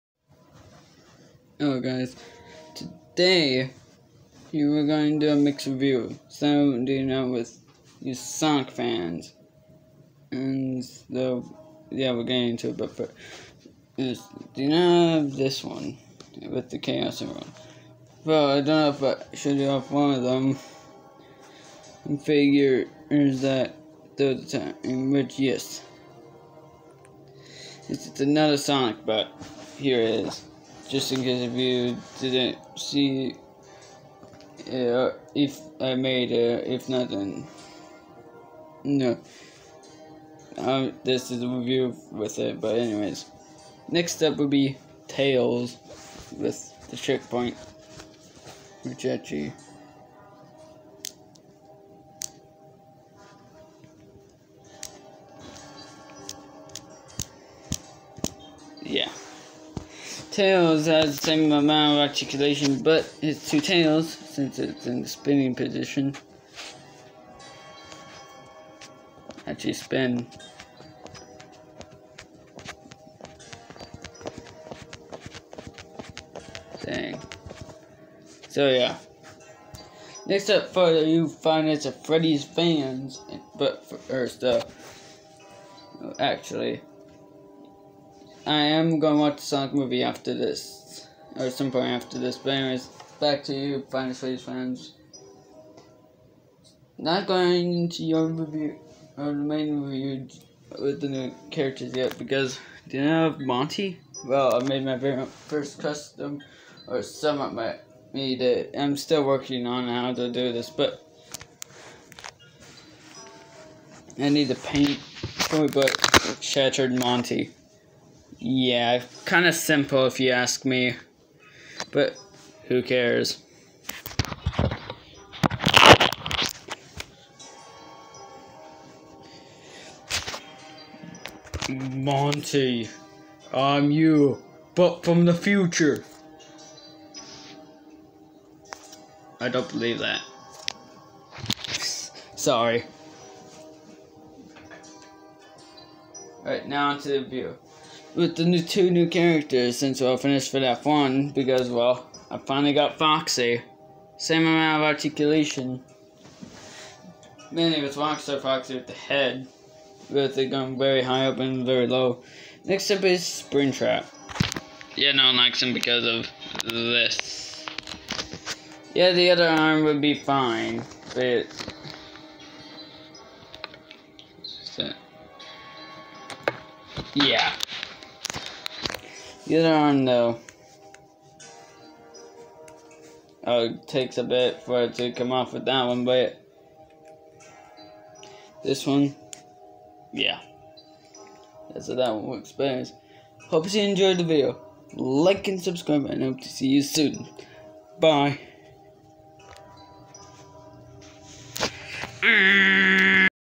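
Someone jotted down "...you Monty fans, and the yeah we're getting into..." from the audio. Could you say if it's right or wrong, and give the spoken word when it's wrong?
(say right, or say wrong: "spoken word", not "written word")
wrong: "Sonic", not "Monty".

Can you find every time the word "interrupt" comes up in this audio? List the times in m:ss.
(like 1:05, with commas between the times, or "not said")
not said.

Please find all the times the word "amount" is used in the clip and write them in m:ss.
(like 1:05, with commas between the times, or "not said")
1:01, 2:34.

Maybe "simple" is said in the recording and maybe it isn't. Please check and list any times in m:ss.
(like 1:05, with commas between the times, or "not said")
1:59.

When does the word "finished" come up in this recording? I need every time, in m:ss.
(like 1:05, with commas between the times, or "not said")
2:30.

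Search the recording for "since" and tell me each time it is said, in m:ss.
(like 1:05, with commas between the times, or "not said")
1:04, 2:29.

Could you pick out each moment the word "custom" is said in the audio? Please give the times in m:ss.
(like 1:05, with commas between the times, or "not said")
1:45.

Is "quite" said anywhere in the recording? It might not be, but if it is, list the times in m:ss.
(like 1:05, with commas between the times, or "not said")
not said.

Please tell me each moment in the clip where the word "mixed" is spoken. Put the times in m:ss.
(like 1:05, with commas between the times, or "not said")
0:05.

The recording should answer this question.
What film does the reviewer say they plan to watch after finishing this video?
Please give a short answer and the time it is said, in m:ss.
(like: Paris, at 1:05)
The Sonic movie, at 1:29.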